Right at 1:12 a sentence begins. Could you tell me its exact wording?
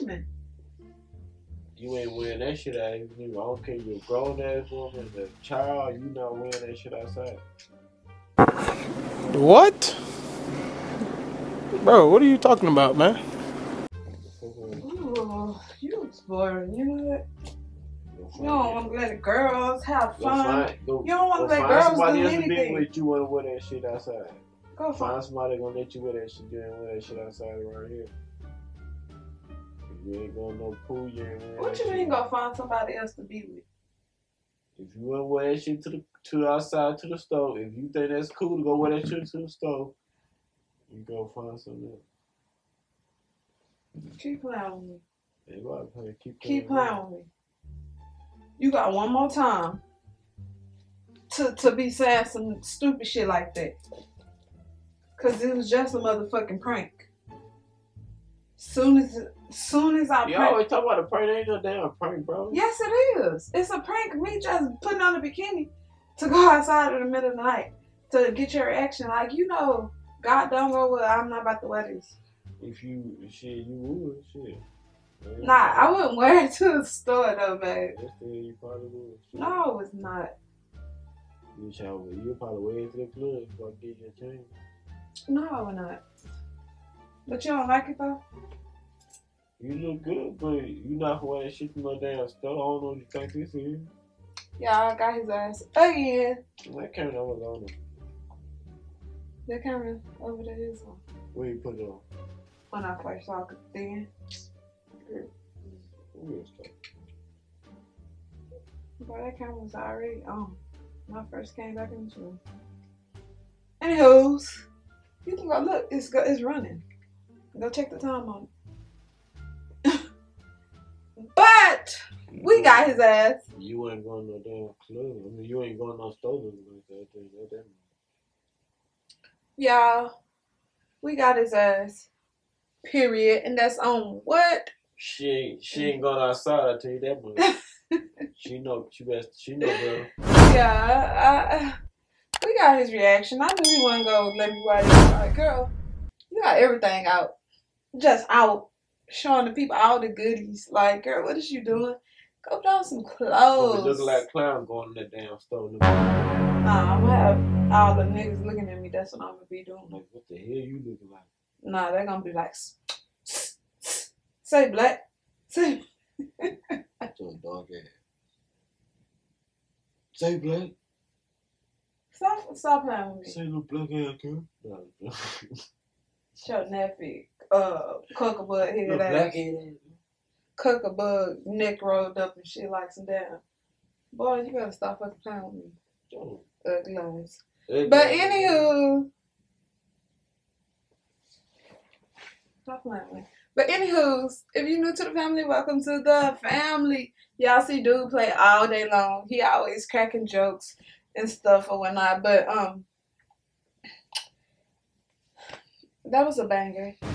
If you shit, you would shit.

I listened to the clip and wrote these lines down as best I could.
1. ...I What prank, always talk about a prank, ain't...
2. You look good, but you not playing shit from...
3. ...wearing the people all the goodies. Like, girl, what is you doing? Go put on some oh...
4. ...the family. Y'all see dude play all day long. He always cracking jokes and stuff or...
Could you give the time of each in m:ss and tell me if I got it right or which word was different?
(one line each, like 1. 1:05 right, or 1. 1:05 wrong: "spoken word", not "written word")
1. 1:00 wrong: "You", not "What"
2. 1:29 wrong: "wearing", not "playing"
3. 2:29 wrong: "showing", not "wearing"
4. 3:16 right.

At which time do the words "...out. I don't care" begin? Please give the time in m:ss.
0:02.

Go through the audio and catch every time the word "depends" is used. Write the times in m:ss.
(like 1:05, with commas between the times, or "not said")
not said.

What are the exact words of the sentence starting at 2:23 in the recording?
I knew he wasn't gonna let me ride this.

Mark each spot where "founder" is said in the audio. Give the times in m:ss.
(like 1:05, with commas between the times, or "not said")
not said.